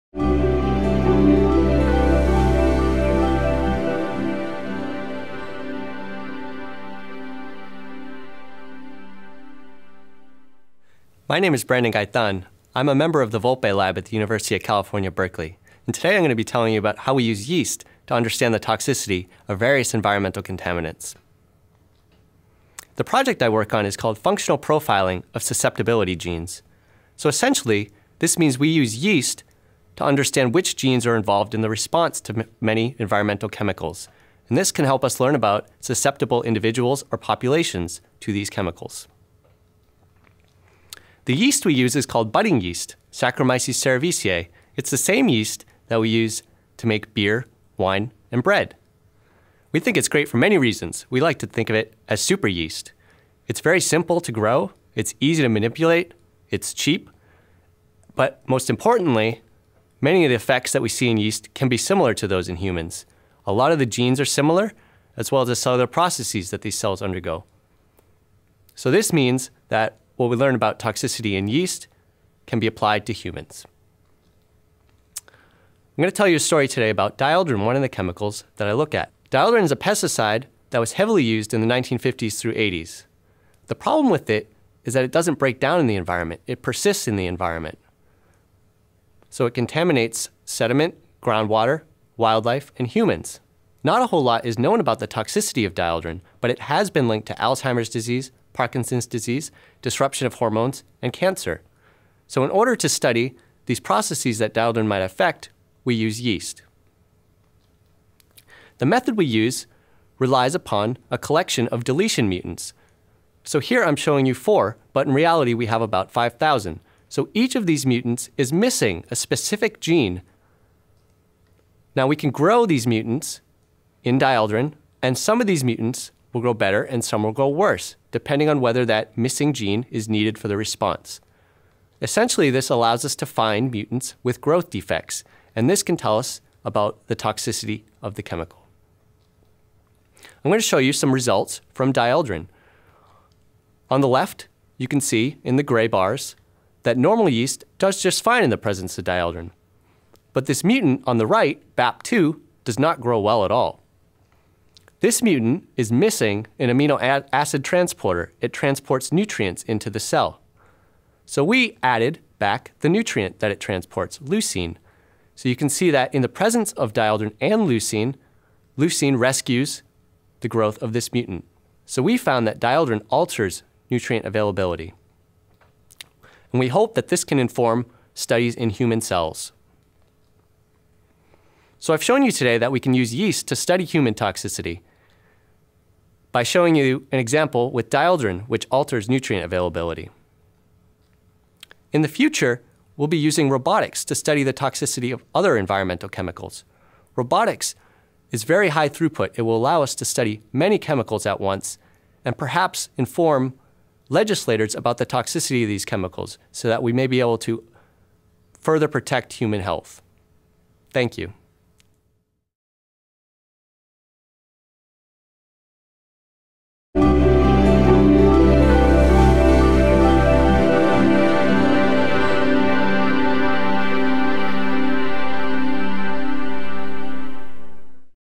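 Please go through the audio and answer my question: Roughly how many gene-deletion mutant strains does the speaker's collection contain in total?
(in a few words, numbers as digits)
5,000.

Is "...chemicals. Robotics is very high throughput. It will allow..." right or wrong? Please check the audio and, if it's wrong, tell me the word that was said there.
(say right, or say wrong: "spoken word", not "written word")
right.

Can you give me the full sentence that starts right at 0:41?
The yeast we use is called budding yeast, Saccharomyces cerevisiae.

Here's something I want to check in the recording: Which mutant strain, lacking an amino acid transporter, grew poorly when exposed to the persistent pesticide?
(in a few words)
BAP2.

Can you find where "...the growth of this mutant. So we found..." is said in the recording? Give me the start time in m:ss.
2:50.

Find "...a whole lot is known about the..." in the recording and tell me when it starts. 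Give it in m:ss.
1:34.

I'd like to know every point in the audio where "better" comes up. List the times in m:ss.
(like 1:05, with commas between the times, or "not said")
2:06.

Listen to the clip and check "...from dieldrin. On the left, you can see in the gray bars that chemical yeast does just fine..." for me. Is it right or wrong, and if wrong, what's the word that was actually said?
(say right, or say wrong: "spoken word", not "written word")
wrong: "normal", not "chemical".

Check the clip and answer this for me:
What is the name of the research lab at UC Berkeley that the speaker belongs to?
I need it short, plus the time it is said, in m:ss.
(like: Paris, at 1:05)
Vulpe Lab, at 0:13.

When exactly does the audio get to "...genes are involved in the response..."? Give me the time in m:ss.
0:30.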